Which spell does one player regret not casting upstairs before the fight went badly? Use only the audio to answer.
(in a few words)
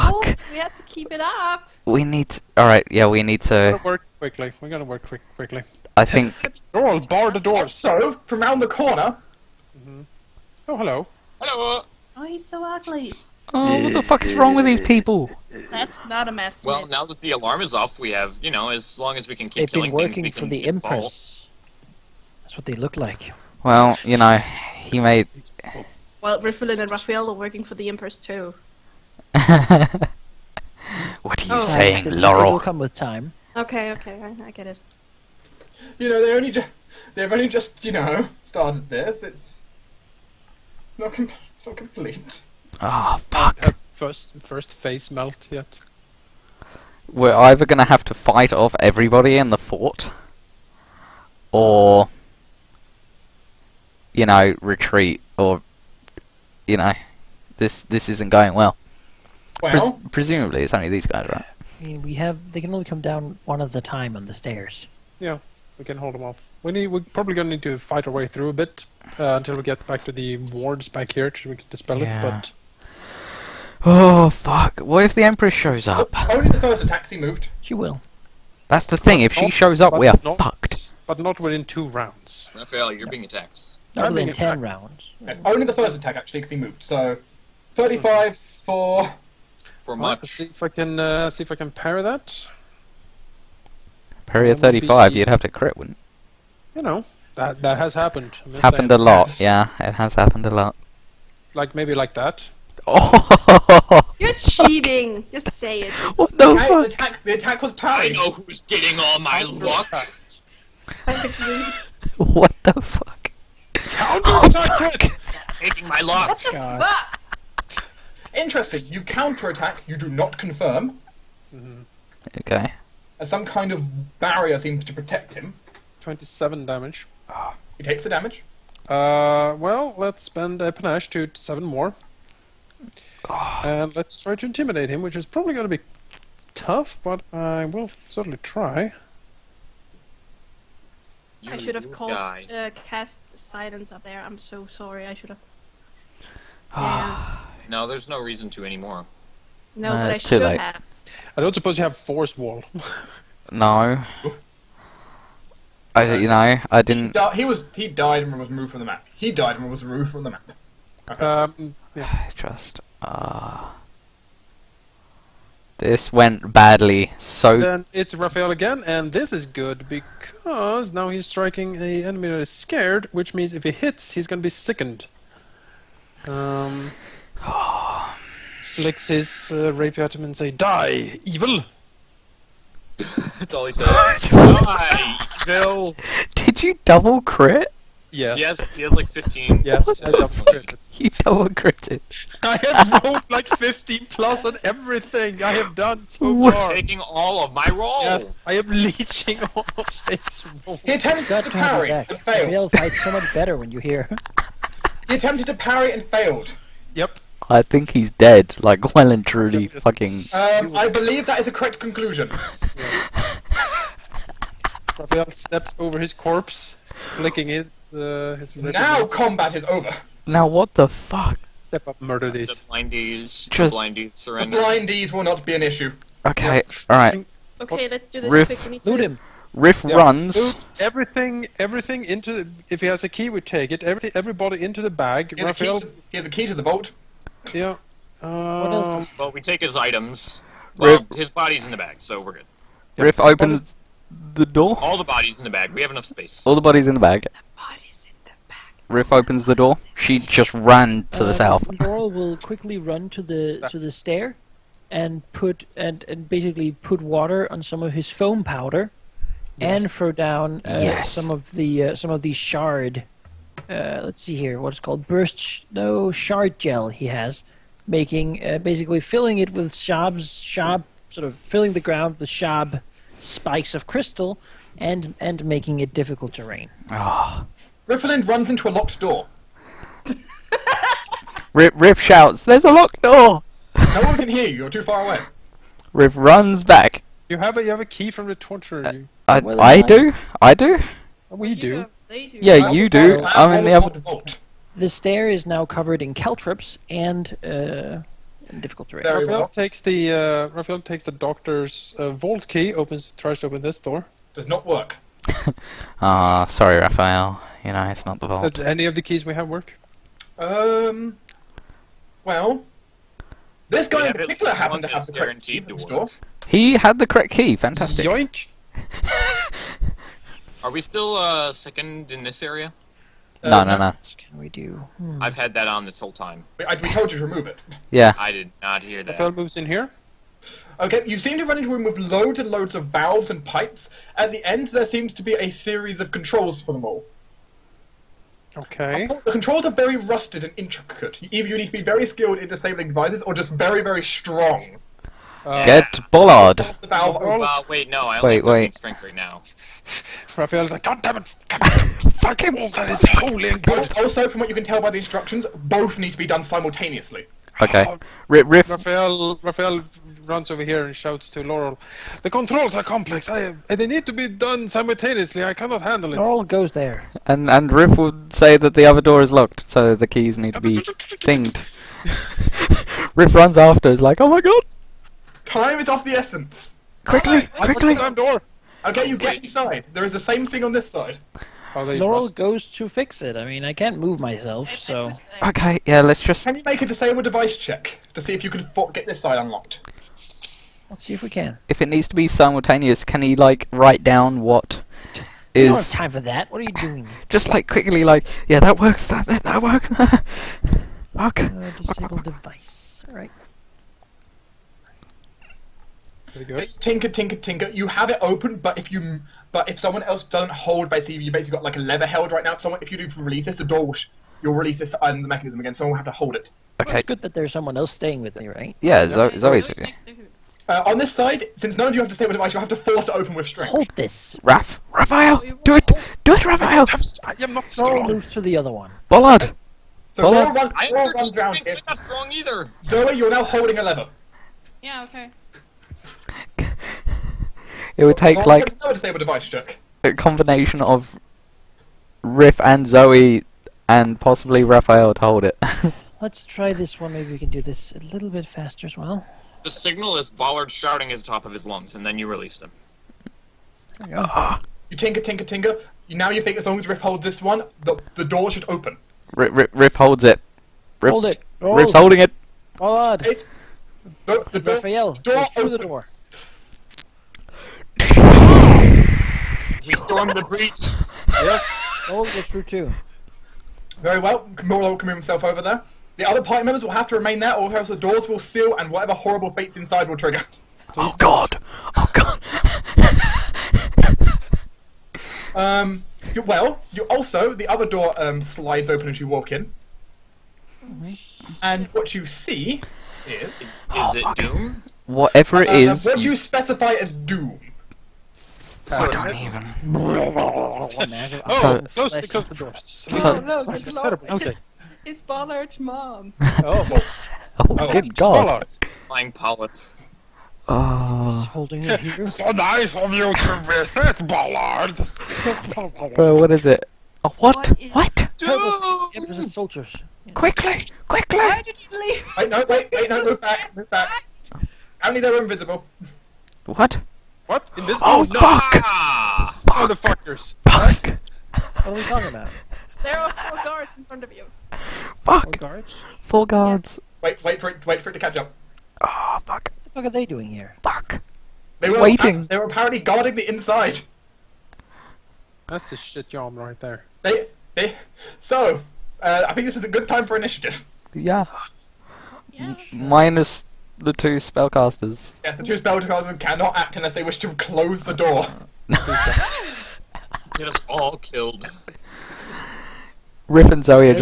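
silence.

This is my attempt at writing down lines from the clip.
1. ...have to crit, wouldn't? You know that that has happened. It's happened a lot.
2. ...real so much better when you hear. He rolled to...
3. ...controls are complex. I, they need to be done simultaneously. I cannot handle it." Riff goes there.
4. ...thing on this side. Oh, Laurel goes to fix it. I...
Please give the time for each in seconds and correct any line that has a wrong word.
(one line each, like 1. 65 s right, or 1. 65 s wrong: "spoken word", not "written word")
1. 95 s right
2. 202 s wrong: "attempted", not "rolled"
3. 362 s wrong: "Laurel", not "Riff"
4. 380 s right.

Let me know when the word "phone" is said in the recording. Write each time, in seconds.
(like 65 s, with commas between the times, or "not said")
not said.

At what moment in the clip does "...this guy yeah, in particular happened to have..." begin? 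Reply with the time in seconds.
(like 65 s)
313 s.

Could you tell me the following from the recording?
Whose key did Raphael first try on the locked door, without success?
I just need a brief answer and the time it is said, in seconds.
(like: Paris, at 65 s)
the doctor's, at 301 s.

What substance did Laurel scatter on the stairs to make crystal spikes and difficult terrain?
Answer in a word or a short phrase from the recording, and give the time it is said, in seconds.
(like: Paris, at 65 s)
shard gel, at 266 s.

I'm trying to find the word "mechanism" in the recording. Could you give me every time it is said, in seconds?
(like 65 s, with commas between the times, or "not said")
415 s.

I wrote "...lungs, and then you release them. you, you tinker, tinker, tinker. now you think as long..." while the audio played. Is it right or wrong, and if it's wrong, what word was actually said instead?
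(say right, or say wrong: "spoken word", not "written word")
right.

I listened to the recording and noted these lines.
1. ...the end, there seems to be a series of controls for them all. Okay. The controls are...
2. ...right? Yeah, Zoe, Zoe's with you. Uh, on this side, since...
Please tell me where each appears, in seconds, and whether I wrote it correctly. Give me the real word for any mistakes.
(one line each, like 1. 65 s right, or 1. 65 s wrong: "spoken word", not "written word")
1. 334 s right
2. 418 s right.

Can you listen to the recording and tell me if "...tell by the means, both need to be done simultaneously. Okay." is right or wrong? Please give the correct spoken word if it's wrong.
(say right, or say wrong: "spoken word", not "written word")
wrong: "instructions", not "means".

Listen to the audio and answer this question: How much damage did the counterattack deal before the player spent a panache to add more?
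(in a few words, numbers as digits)
27.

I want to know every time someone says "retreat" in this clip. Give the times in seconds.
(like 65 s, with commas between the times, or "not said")
54 s.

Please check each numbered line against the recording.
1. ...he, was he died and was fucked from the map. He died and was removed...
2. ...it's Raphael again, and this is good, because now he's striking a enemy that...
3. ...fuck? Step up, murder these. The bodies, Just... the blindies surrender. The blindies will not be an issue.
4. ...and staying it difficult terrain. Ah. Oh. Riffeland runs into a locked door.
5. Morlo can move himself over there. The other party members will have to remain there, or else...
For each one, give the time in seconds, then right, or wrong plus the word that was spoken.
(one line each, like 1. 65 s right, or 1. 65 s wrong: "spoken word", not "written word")
1. 157 s wrong: "removed", not "fucked"
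2. 167 s right
3. 220 s wrong: "blindies", not "bodies"
4. 275 s wrong: "making", not "staying"
5. 474 s right.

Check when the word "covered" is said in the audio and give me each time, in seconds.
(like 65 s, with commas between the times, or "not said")
295 s.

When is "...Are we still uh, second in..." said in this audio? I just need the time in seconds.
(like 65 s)
320 s.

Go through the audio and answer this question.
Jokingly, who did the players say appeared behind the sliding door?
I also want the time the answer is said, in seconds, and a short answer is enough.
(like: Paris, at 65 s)
Bollard's mom, at 505 s.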